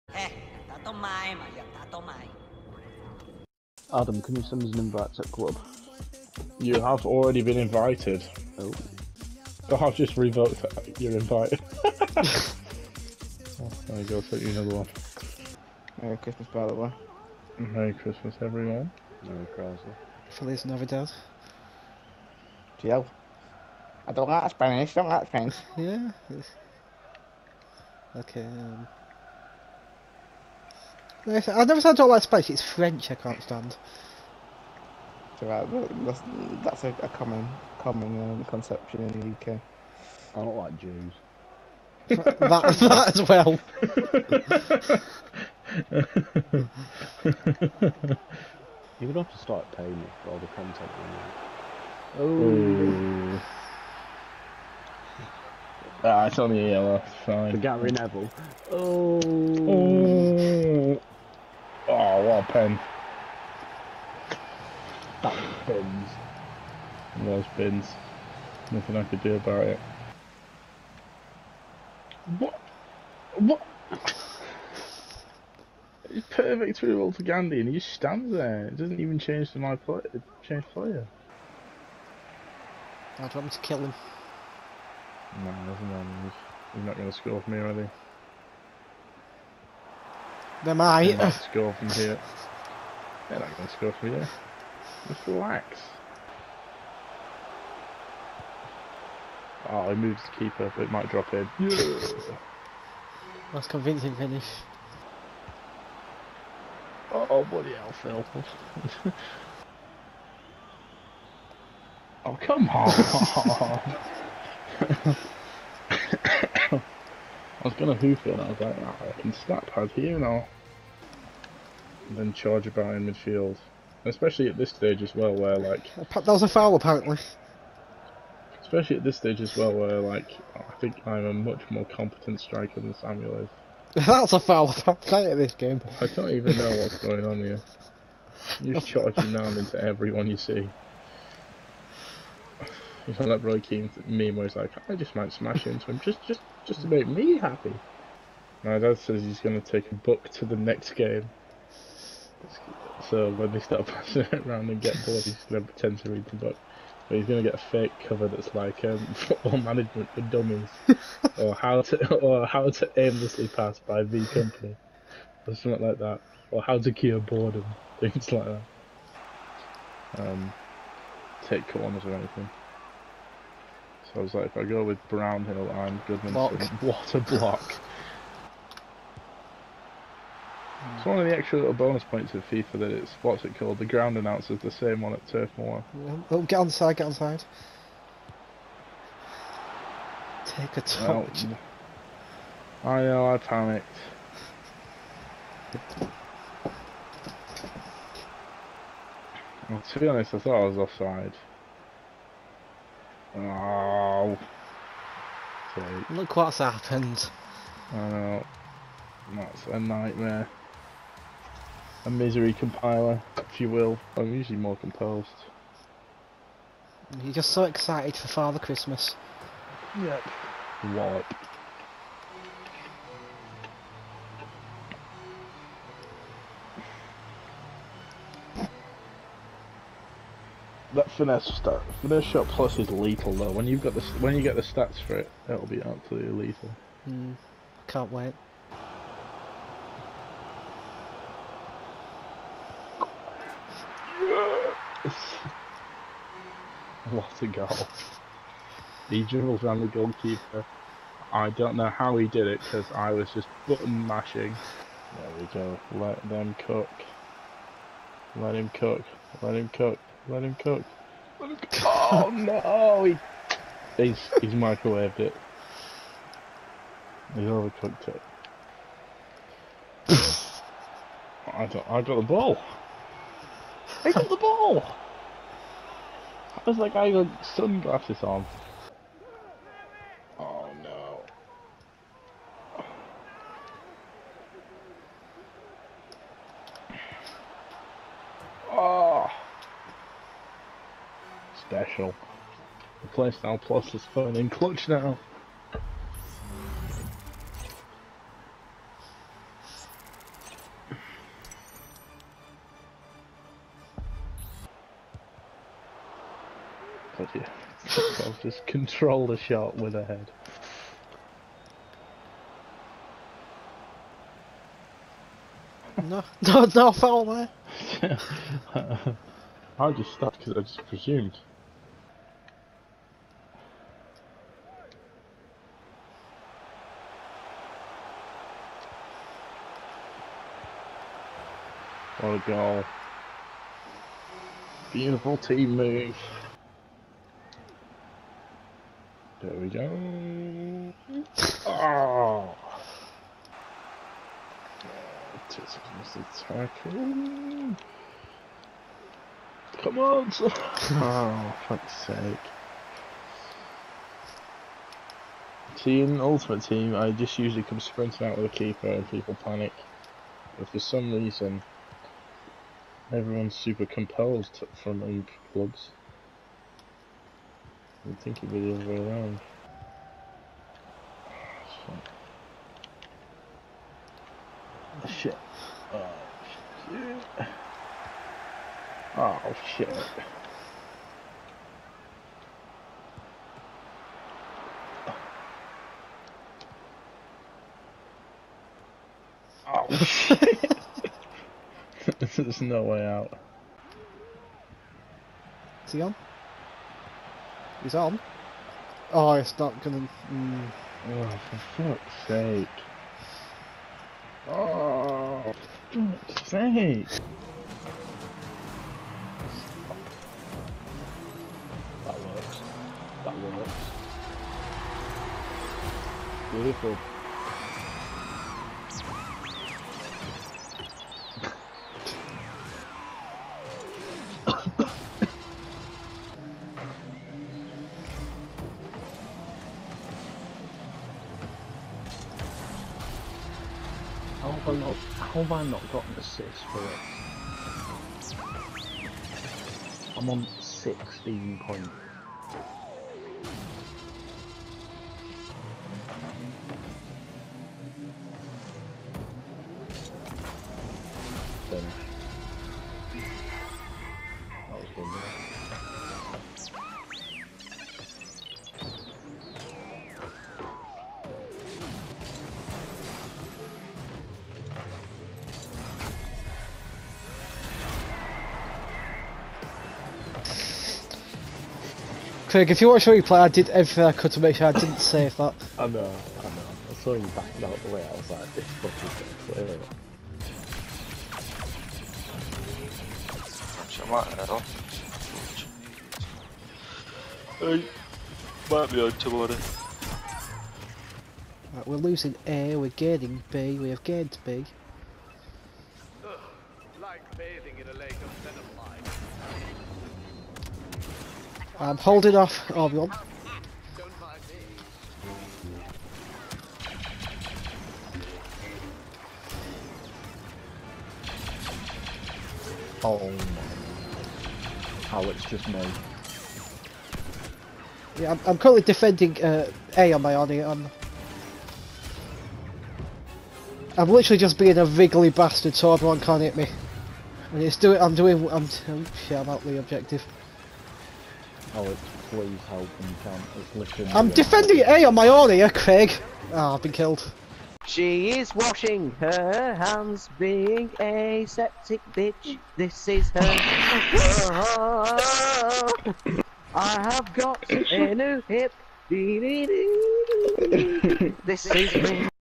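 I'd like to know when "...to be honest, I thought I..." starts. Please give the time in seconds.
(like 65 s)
199 s.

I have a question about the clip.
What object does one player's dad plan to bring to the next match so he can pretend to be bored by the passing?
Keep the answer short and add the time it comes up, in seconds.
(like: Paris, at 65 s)
A book, at 149 s.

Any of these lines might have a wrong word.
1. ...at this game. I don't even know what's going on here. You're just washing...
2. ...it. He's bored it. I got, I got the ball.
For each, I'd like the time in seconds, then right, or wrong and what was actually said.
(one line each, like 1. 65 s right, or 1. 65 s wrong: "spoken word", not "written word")
1. 135 s wrong: "charging", not "washing"
2. 265 s wrong: "overcooked", not "bored".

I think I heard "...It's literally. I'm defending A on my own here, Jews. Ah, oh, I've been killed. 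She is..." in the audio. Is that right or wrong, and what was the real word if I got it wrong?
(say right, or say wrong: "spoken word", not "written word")
wrong: "Craig", not "Jews".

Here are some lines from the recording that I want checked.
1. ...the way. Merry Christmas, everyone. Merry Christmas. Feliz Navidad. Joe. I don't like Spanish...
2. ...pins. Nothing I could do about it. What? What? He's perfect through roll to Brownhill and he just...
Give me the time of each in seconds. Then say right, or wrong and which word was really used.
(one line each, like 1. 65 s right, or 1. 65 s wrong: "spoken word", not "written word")
1. 16 s right
2. 67 s wrong: "Gandhi", not "Brownhill".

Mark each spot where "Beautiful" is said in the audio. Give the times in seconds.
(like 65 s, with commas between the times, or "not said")
334 s, 416 s.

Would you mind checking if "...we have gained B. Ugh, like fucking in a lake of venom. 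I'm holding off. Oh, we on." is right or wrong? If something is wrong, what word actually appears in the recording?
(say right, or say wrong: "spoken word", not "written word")
wrong: "bathing", not "fucking".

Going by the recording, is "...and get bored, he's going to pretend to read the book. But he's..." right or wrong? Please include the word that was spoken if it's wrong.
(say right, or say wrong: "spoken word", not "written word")
right.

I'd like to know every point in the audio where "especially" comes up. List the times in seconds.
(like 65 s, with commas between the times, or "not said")
124 s, 128 s.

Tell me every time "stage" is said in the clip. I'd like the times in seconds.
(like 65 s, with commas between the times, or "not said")
124 s, 129 s.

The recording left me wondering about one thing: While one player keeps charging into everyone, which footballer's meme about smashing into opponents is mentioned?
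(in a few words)
Roy Keane.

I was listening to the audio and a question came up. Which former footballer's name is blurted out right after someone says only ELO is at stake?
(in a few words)
Gary Neville.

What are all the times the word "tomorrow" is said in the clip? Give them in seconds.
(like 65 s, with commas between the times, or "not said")
489 s.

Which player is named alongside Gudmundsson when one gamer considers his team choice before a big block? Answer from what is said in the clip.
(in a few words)
Brownhill.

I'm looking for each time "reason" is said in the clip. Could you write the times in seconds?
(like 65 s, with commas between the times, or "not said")
361 s.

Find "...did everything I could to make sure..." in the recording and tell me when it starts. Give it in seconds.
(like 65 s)
473 s.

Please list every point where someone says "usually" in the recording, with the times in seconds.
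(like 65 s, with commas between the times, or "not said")
214 s, 357 s.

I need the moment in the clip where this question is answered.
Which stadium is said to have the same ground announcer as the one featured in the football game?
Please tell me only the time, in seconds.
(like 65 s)
185 s.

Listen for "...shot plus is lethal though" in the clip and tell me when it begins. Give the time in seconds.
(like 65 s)
232 s.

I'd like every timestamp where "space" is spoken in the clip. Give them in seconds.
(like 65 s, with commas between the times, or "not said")
32 s.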